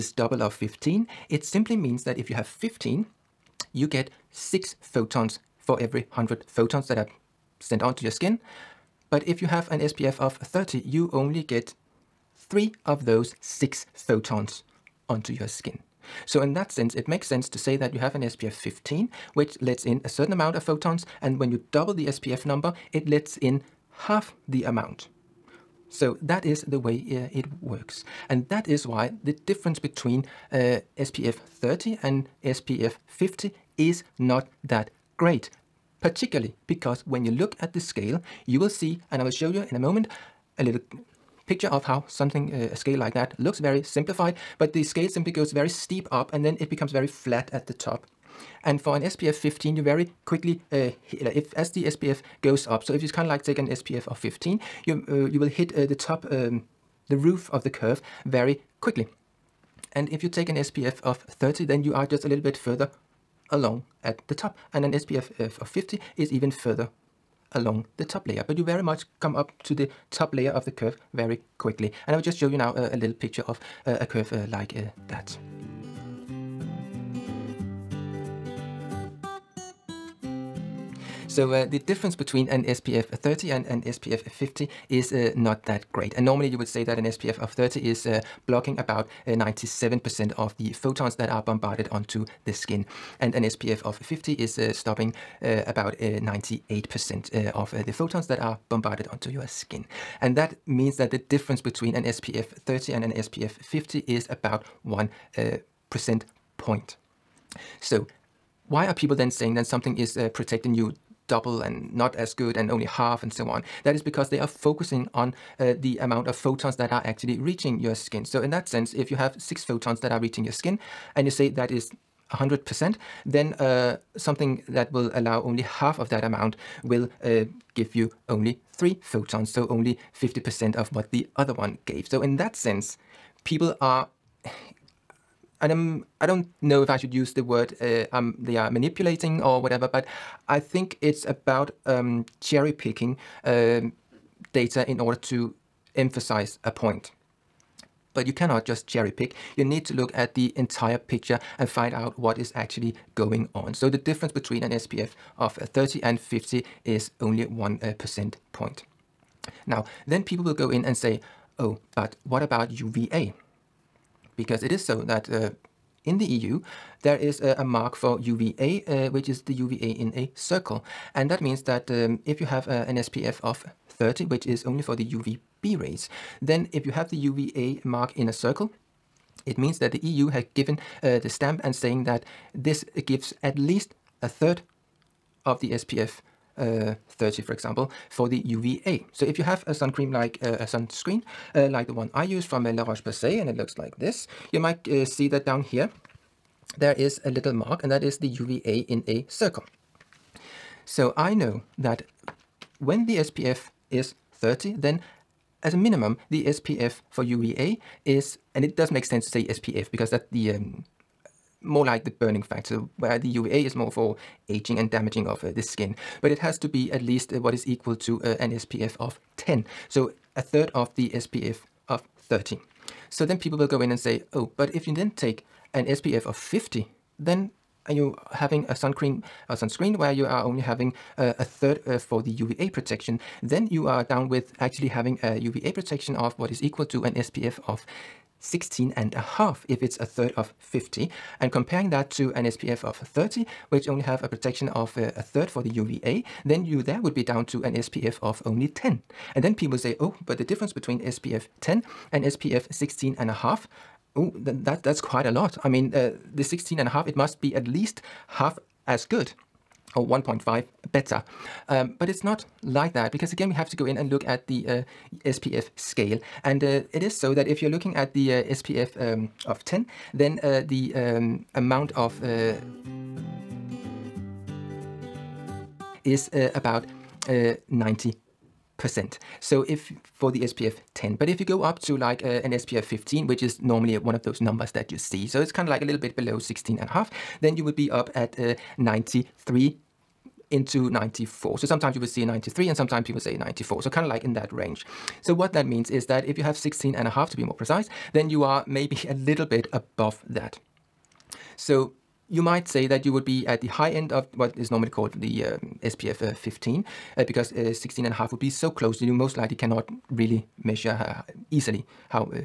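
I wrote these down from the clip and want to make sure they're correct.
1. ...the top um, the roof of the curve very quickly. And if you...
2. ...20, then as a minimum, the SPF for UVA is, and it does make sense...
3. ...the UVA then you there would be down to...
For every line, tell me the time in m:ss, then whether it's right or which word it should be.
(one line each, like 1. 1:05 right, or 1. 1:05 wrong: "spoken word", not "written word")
1. 0:55 right
2. 3:24 wrong: "30", not "20"
3. 4:05 right.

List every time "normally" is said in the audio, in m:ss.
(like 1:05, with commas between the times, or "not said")
1:26, 4:43, 5:04.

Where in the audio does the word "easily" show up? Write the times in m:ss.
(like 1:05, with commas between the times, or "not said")
5:11.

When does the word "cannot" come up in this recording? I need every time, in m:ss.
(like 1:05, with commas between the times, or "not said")
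2:28, 5:09.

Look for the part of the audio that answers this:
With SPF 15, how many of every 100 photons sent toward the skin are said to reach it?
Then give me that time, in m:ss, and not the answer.
0:03.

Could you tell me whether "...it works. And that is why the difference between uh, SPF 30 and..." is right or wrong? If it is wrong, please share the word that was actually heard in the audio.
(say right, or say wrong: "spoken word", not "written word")
right.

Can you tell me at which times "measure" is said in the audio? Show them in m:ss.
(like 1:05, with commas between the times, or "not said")
5:10.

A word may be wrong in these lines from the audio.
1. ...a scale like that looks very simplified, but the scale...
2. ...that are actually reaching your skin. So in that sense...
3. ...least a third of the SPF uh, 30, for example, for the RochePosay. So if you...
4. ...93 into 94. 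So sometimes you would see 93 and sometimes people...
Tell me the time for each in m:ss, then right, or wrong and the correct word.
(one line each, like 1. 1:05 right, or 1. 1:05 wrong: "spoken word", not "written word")
1. 0:42 right
2. 1:56 right
3. 3:03 wrong: "UVA", not "RochePosay"
4. 4:48 right.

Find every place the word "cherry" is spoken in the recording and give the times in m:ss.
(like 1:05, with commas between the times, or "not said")
2:22, 2:28.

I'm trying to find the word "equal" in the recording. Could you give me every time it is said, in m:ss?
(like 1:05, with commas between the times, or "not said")
3:37, 3:56.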